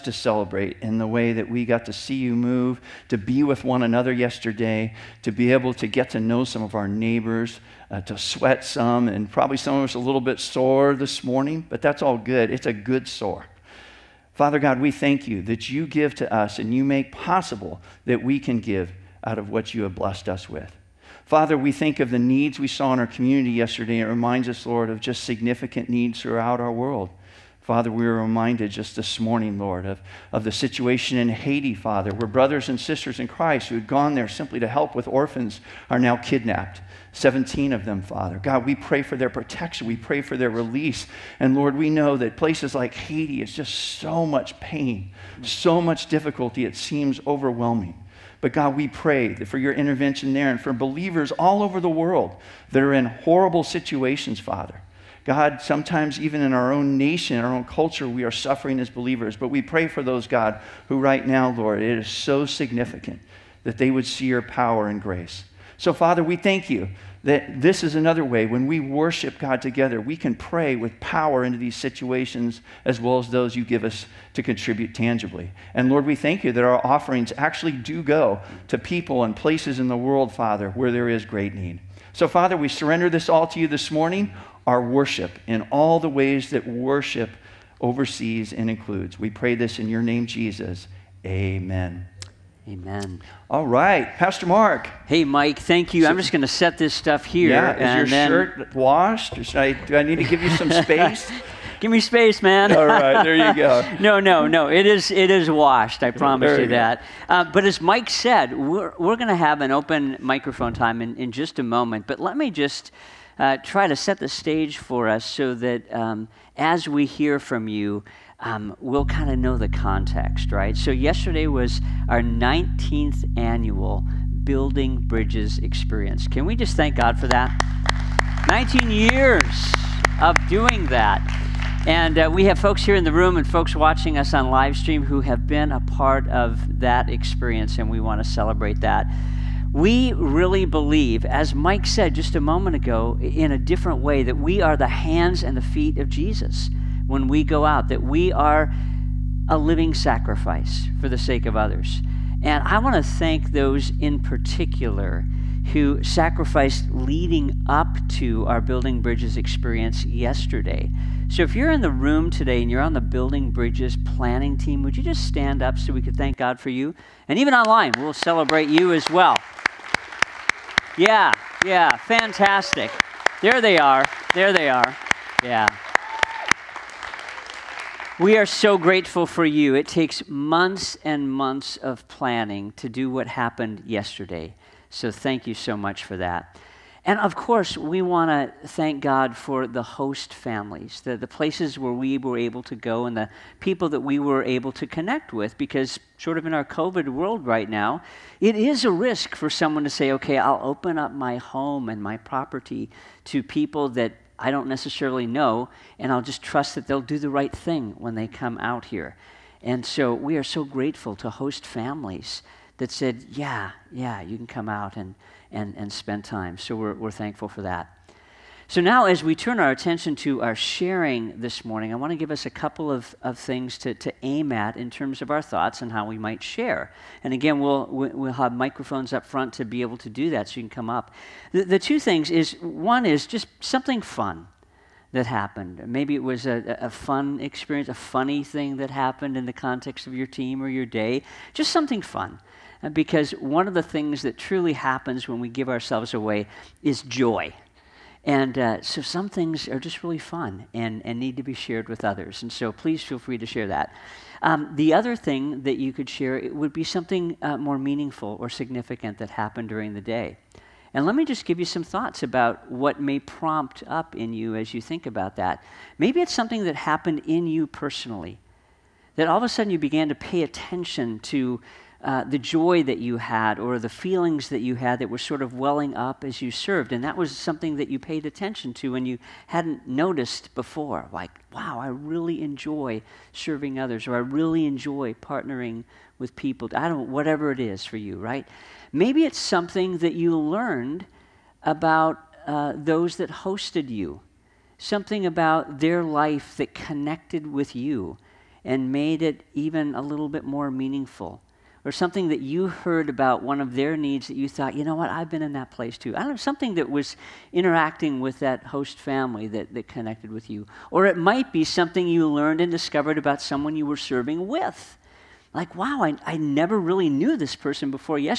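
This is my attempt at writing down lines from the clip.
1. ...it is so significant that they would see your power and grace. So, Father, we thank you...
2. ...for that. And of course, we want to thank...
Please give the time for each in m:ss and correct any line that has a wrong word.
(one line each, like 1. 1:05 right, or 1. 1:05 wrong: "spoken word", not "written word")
1. 1:01 right
2. 3:06 right.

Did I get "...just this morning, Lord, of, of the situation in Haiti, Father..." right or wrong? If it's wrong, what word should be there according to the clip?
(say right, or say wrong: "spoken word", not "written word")
right.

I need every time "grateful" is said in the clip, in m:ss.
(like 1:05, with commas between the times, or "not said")
2:58, 3:30.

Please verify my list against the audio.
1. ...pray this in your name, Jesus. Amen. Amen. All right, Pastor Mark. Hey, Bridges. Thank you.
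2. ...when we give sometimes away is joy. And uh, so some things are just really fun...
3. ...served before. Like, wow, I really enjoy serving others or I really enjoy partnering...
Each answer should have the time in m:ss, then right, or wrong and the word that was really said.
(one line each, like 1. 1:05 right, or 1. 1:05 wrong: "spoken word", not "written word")
1. 1:29 wrong: "Mike", not "Bridges"
2. 4:05 wrong: "ourselves", not "sometimes"
3. 4:39 wrong: "noticed", not "served".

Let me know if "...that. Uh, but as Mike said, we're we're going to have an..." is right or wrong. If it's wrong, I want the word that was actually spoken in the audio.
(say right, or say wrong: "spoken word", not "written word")
right.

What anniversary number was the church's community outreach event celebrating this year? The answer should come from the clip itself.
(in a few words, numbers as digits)
19th.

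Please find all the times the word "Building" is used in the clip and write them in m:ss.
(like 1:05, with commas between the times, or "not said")
2:04, 2:38, 2:43.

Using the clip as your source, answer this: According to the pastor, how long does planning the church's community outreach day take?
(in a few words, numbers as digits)
months and months.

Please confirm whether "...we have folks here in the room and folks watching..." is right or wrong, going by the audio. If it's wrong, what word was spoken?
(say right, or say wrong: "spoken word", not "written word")
right.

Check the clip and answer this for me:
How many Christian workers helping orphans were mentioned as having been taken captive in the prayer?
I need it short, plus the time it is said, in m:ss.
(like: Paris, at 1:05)
17, at 0:37.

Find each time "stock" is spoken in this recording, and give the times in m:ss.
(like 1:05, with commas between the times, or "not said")
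not said.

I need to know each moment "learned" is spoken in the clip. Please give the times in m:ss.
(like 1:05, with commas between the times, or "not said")
4:50, 5:12.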